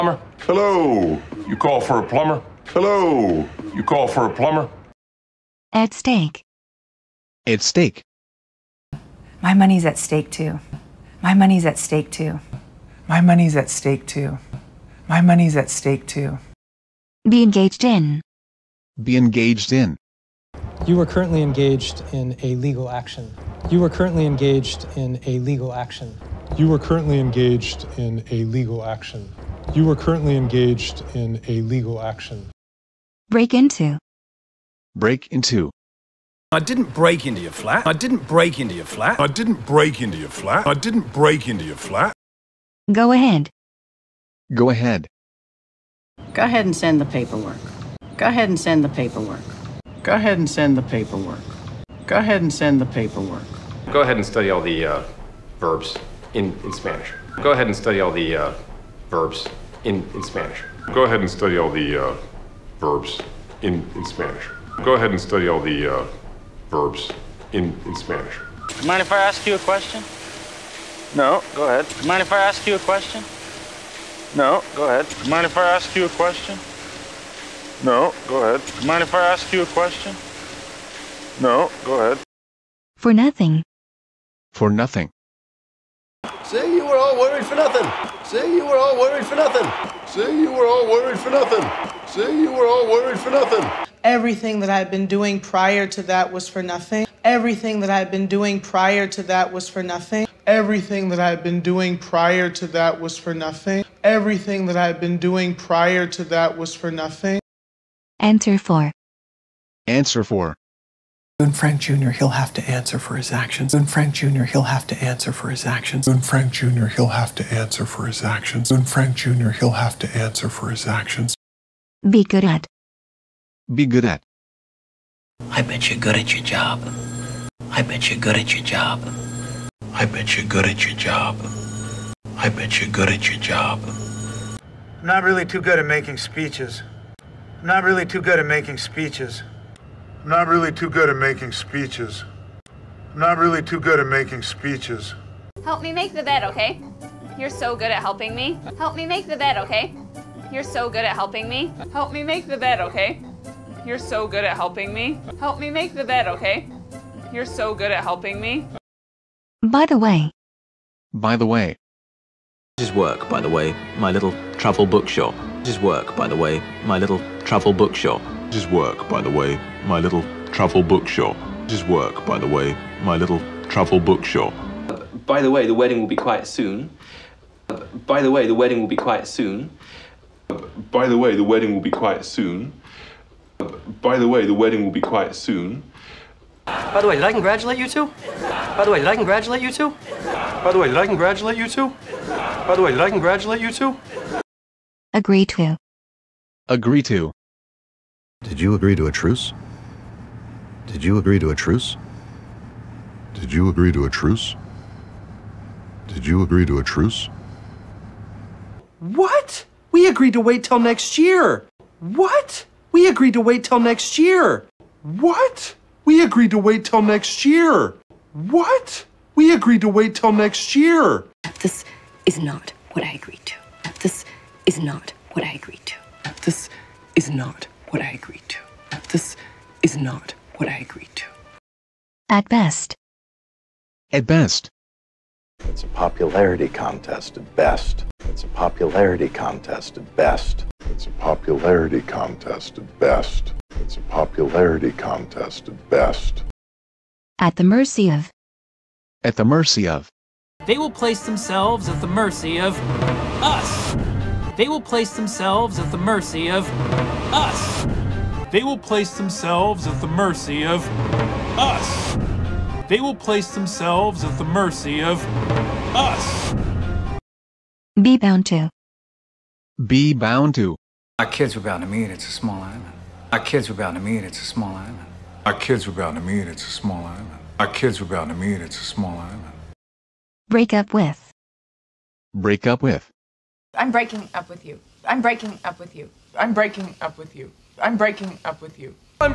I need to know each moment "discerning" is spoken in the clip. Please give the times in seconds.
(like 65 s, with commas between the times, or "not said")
not said.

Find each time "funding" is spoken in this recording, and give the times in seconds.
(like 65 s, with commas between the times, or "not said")
not said.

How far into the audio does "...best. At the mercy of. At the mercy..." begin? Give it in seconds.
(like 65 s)
245 s.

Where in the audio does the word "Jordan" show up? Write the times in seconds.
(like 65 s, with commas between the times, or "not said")
not said.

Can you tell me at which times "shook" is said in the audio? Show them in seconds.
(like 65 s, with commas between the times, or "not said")
not said.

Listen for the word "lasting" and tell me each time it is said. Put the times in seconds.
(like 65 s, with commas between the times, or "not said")
not said.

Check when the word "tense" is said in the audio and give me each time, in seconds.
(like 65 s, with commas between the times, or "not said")
not said.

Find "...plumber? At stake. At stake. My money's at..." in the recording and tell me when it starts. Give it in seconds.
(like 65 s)
4 s.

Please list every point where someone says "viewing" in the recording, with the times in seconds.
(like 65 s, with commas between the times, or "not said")
not said.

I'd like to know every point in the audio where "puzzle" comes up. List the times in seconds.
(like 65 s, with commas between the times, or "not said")
not said.